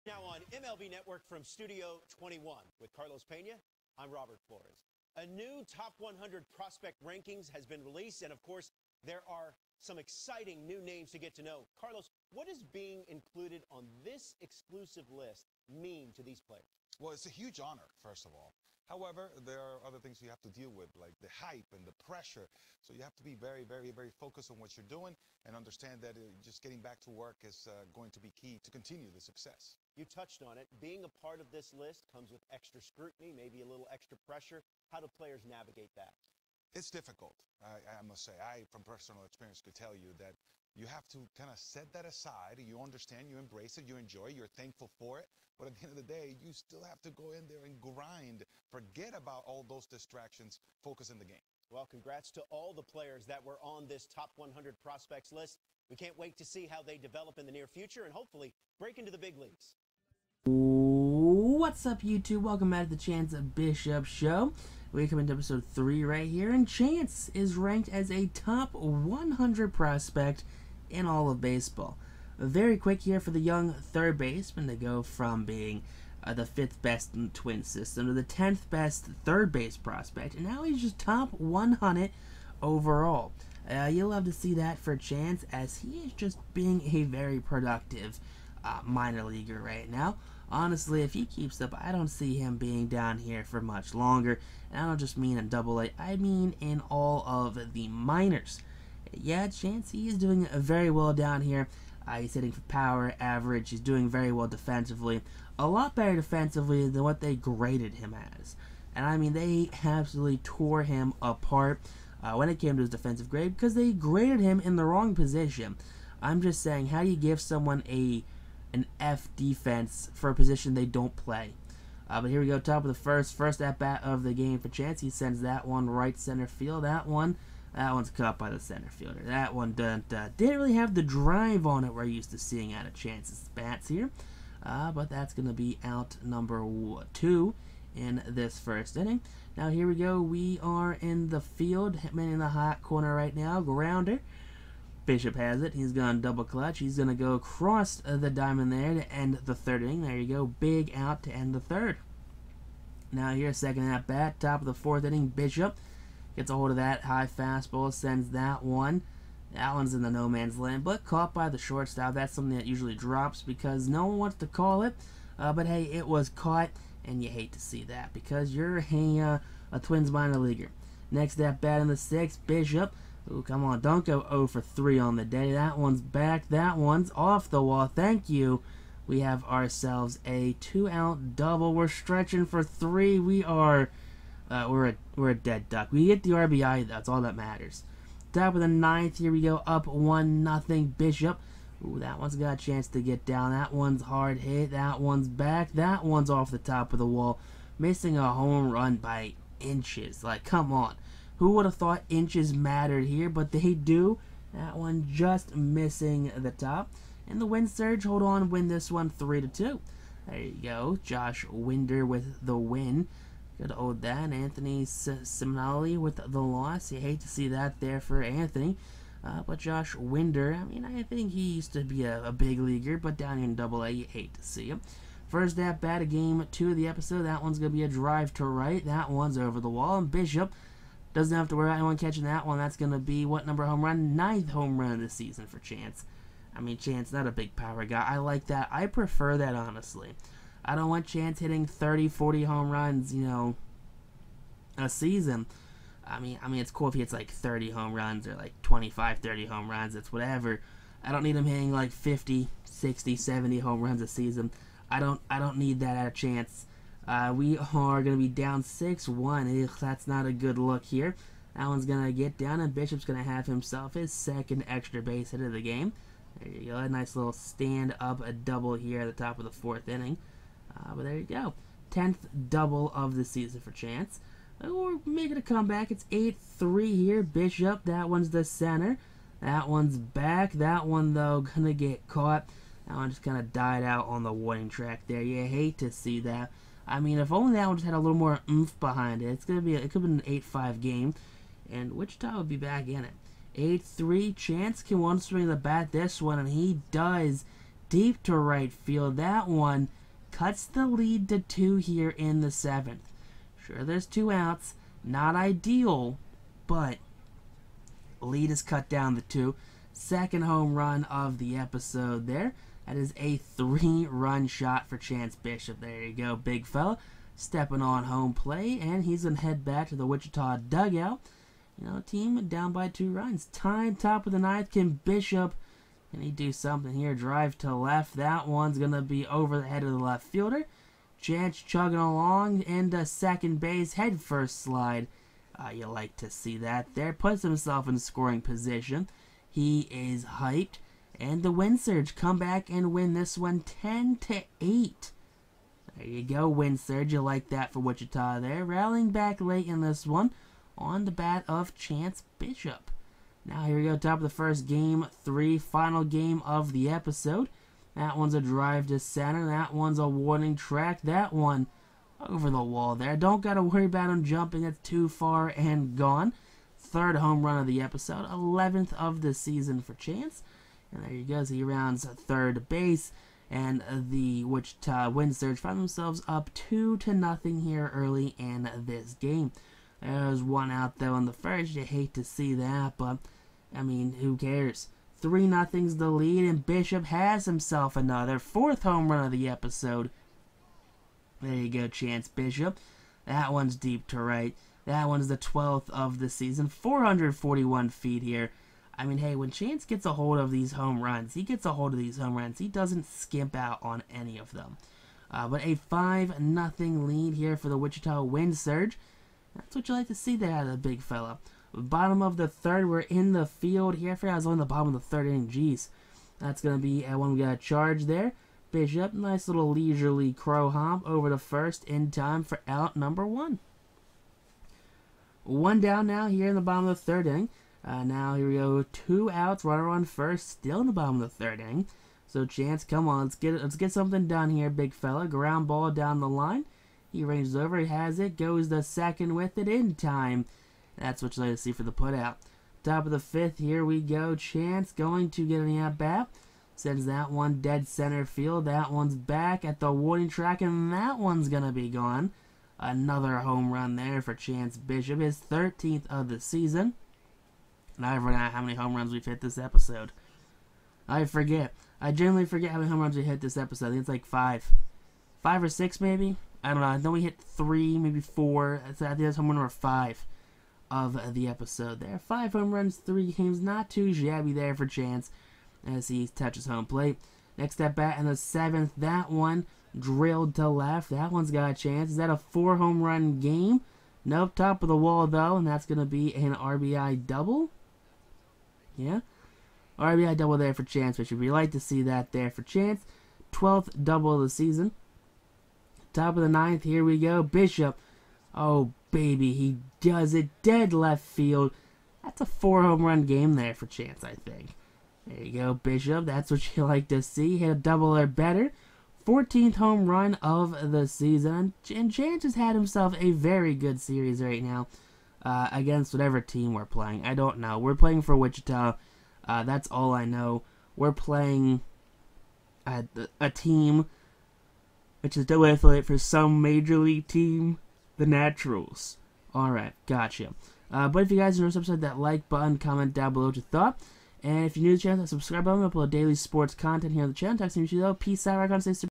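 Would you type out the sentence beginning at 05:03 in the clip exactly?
Sure, there's two outs, not ideal, but lead is cut down to two.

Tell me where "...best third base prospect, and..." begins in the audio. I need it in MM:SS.
01:18.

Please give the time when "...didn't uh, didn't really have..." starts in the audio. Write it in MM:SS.
02:09.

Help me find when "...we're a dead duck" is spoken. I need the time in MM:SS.
03:05.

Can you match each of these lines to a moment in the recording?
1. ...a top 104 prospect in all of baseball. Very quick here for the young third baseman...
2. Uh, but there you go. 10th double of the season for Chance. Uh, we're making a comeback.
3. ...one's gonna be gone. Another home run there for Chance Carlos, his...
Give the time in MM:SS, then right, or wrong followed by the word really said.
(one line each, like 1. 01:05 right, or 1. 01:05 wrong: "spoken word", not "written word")
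1. 01:08 wrong: "100", not "104"
2. 04:30 right
3. 07:31 wrong: "Bishop", not "Carlos".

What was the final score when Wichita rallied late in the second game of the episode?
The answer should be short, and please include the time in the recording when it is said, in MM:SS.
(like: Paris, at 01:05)
10 to 8, at 05:43.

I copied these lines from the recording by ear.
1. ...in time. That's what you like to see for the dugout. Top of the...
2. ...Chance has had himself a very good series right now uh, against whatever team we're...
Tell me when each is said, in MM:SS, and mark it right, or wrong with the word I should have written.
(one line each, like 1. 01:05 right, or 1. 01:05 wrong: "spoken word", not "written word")
1. 07:19 wrong: "putout", not "dugout"
2. 08:32 right.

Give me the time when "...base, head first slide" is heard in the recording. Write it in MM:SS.
05:33.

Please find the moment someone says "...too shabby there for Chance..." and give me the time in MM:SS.
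07:53.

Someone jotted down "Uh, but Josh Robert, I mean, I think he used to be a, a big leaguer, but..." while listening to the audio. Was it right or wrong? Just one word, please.
wrong.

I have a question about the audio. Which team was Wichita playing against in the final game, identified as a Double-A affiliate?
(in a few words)
the Naturals.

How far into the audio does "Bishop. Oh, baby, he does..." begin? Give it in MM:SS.
08:17.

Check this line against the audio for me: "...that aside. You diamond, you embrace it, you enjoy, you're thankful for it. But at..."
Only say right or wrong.
wrong.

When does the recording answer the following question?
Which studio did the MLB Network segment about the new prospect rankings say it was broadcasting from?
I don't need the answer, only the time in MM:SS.
00:01.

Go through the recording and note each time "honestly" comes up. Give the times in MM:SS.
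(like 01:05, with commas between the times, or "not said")
01:30, 03:59.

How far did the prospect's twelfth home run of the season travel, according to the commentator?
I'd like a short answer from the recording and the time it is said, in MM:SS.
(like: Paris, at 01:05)
441 feet, at 06:36.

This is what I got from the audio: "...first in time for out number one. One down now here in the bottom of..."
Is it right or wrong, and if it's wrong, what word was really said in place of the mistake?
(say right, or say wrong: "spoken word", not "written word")
right.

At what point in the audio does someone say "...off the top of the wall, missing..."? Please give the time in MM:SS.
03:16.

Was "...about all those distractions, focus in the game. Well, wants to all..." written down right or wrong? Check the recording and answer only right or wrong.
wrong.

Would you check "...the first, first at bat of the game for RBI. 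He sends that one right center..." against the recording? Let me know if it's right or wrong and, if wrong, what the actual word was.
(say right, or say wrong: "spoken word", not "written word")
wrong: "Chance", not "RBI".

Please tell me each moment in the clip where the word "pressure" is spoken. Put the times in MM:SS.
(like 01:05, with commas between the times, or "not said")
00:21, 00:34.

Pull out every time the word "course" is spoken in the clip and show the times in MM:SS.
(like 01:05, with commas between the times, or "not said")
00:08.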